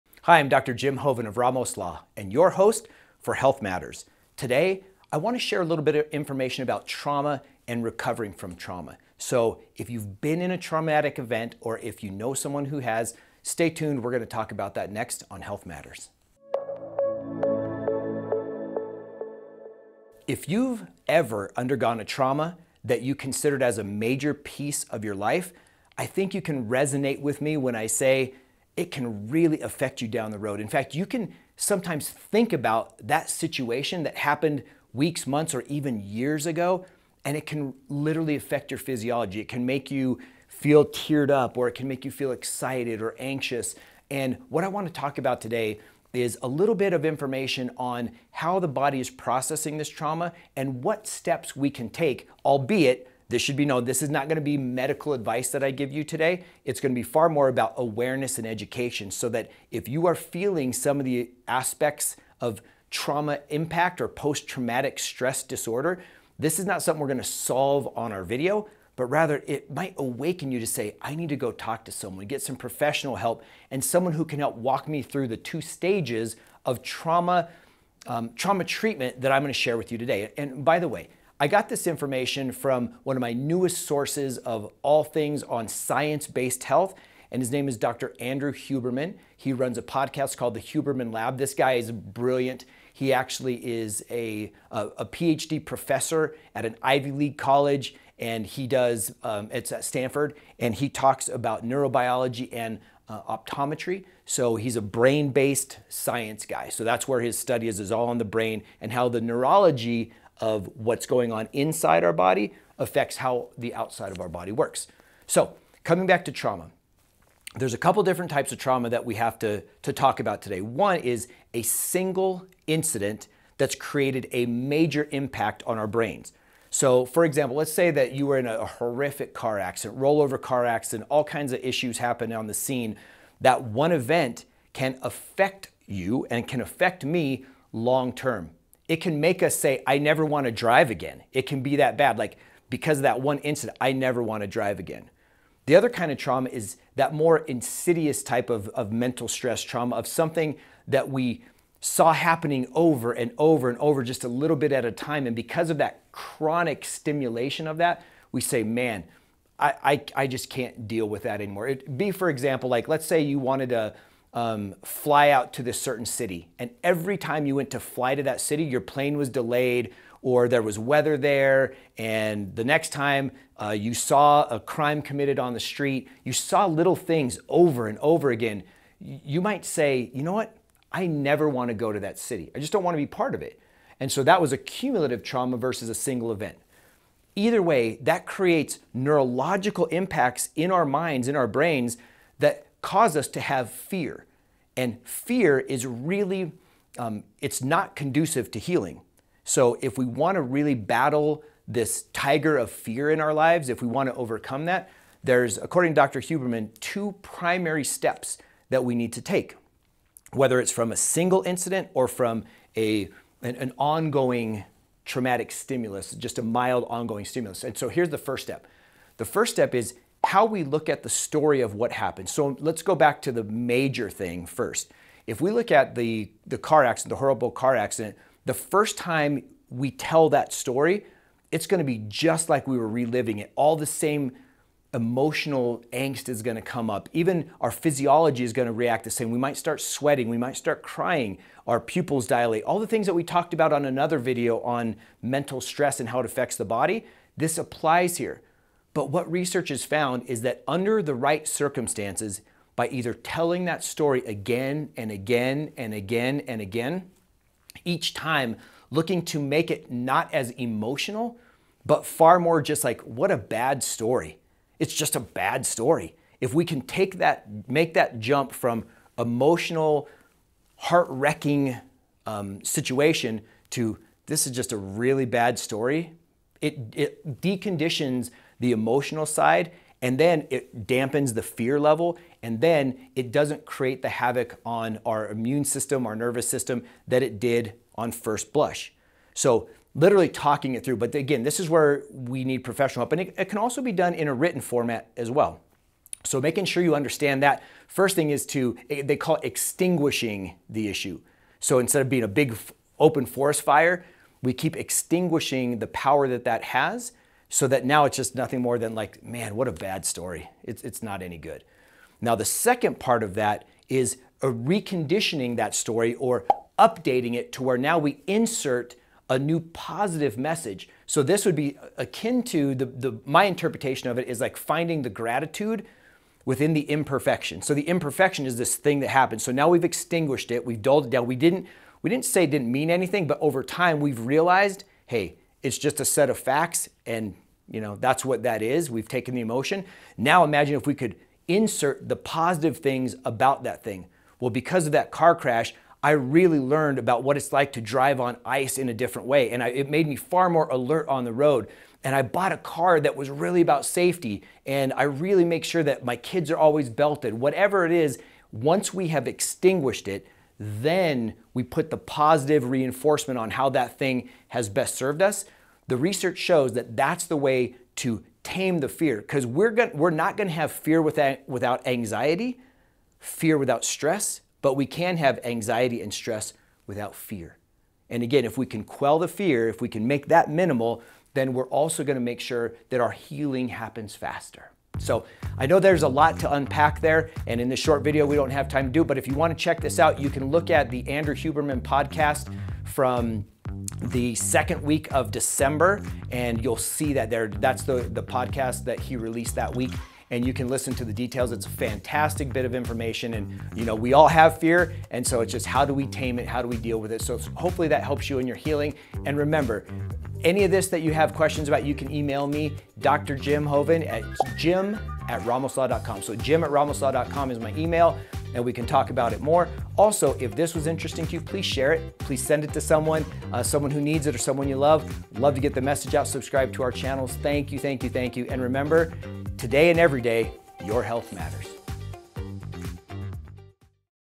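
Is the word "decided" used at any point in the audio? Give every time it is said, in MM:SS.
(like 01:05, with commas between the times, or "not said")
not said.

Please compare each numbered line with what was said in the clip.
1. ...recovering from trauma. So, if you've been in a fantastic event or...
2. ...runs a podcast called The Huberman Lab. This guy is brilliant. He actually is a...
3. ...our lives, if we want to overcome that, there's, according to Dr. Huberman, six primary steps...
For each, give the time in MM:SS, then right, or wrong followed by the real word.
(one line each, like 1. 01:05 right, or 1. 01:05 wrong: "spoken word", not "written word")
1. 00:07 wrong: "traumatic", not "fantastic"
2. 01:29 right
3. 03:23 wrong: "two", not "six".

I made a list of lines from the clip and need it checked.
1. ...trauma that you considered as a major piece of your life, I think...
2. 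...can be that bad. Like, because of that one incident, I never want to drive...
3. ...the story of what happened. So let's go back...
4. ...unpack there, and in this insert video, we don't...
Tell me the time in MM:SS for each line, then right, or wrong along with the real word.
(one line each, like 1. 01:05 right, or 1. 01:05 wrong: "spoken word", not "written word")
1. 00:22 right
2. 02:21 right
3. 03:41 right
4. 06:26 wrong: "short", not "insert".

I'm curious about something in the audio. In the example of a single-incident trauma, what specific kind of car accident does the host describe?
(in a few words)
Rollover car accident.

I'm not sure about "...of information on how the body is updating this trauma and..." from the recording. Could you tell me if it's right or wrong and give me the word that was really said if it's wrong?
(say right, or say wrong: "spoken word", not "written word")
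wrong: "processing", not "updating".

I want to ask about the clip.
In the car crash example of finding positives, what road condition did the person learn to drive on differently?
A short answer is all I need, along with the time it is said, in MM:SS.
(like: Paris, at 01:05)
Ice, at 05:48.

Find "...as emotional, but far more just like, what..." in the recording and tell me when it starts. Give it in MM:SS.
04:20.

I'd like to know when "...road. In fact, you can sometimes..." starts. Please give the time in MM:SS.
00:30.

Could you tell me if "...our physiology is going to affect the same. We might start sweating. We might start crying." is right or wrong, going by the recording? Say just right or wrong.
wrong.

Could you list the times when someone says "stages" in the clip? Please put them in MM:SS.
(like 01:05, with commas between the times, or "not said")
01:15.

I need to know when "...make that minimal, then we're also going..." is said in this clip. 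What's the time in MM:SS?
06:20.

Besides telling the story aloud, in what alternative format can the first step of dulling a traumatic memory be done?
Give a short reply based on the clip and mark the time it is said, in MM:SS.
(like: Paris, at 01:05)
Written format, at 04:54.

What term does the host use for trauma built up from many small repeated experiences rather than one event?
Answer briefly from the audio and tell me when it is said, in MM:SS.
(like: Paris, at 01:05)
Cumulative trauma, at 03:04.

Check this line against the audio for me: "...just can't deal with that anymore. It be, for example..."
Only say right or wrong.
right.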